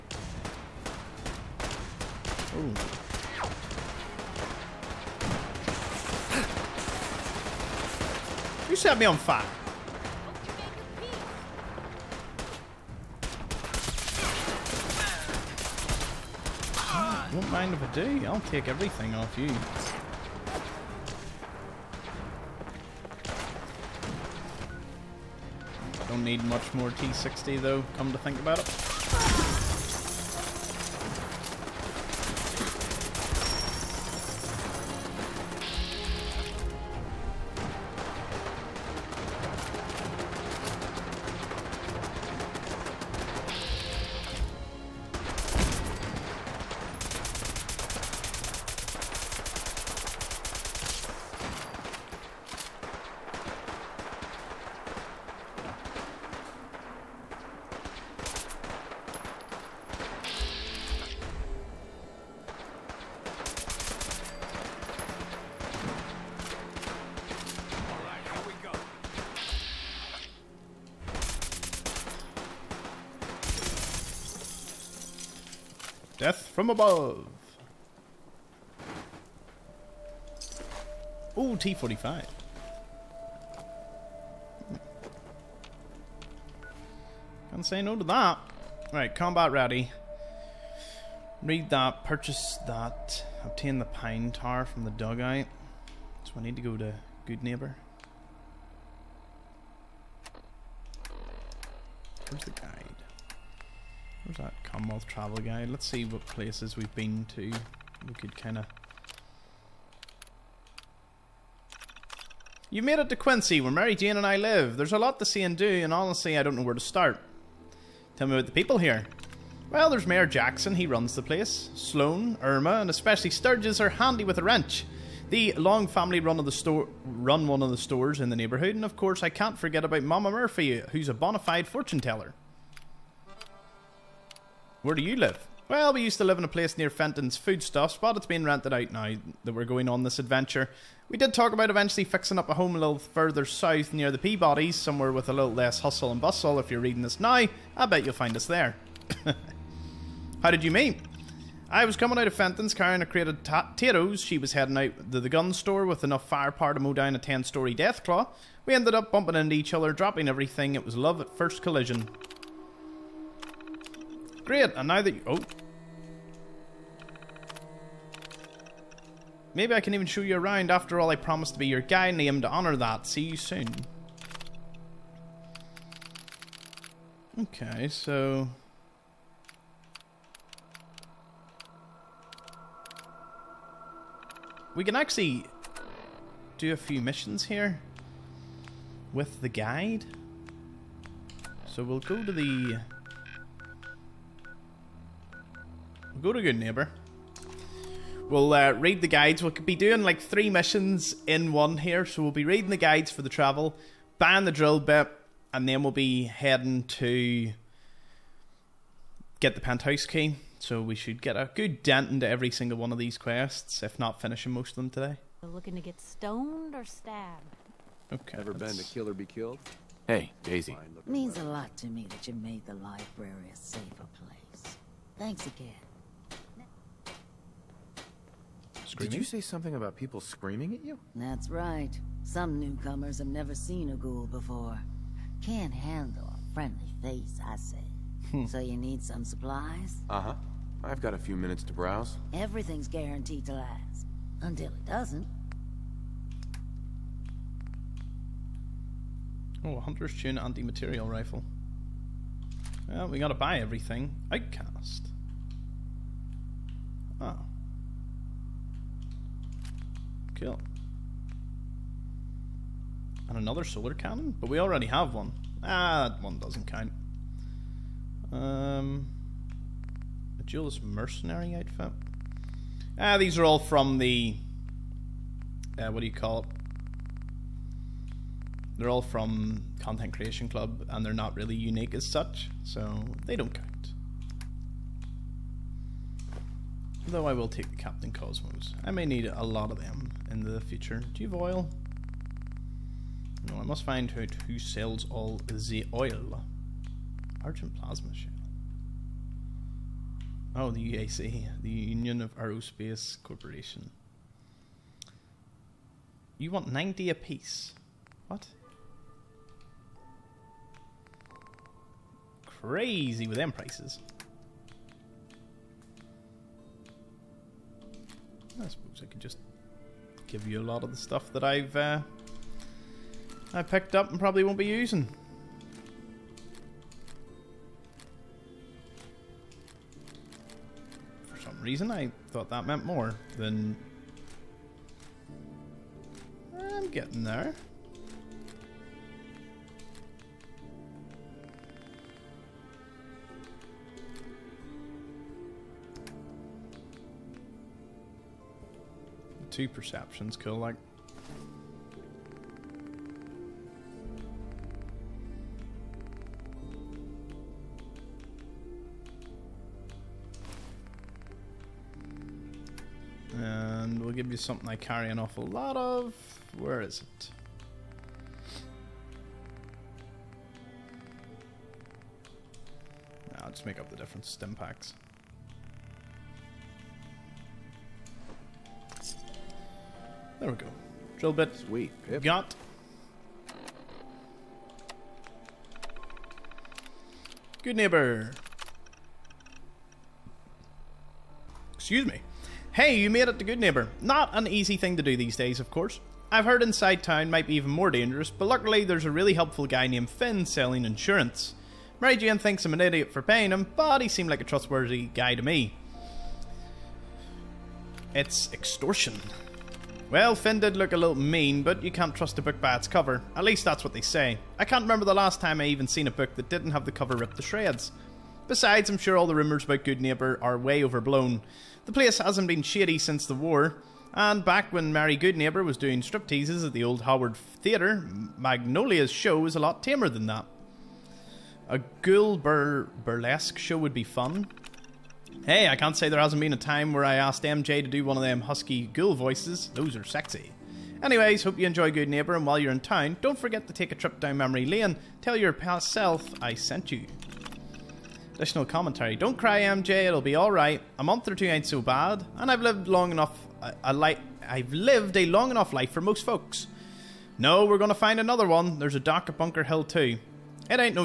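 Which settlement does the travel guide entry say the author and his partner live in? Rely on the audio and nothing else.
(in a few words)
Quincy.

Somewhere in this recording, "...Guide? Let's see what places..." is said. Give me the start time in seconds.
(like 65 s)
105 s.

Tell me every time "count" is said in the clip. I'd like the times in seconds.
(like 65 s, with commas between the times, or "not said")
266 s, 283 s.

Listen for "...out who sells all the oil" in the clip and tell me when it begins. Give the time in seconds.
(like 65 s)
294 s.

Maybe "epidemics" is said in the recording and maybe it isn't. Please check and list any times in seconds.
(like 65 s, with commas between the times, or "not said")
not said.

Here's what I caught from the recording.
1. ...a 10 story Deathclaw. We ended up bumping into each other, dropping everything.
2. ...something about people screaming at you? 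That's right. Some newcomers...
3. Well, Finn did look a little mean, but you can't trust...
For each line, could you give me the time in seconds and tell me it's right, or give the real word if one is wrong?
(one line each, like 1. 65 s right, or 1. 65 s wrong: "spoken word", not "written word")
1. 157 s right
2. 229 s right
3. 410 s right.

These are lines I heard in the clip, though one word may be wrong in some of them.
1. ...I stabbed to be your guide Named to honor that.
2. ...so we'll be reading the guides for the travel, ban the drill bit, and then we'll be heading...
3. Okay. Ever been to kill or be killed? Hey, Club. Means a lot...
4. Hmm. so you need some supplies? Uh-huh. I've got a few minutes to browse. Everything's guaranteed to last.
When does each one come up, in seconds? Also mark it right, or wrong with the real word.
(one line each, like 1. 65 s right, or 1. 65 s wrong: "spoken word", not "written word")
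1. 171 s wrong: "promised", not "stabbed"
2. 202 s right
3. 218 s wrong: "Daisy", not "Club"
4. 238 s right.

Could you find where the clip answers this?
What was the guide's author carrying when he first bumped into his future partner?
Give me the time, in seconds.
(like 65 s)
153 s.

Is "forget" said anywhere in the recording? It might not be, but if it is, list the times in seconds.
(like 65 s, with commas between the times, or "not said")
129 s, 443 s.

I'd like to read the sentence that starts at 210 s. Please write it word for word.
So we should get a good dent into every single one of these quests, if not finishing most of them today.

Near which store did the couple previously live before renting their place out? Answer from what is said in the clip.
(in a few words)
Fenton's Foodstuffs.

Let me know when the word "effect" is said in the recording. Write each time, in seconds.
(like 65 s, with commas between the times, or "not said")
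not said.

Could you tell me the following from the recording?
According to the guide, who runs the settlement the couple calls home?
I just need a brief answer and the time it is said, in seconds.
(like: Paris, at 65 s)
Mayor Jackson, at 120 s.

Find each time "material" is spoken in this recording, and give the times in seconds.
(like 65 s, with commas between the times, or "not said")
250 s.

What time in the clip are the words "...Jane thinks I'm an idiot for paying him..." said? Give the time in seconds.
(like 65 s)
402 s.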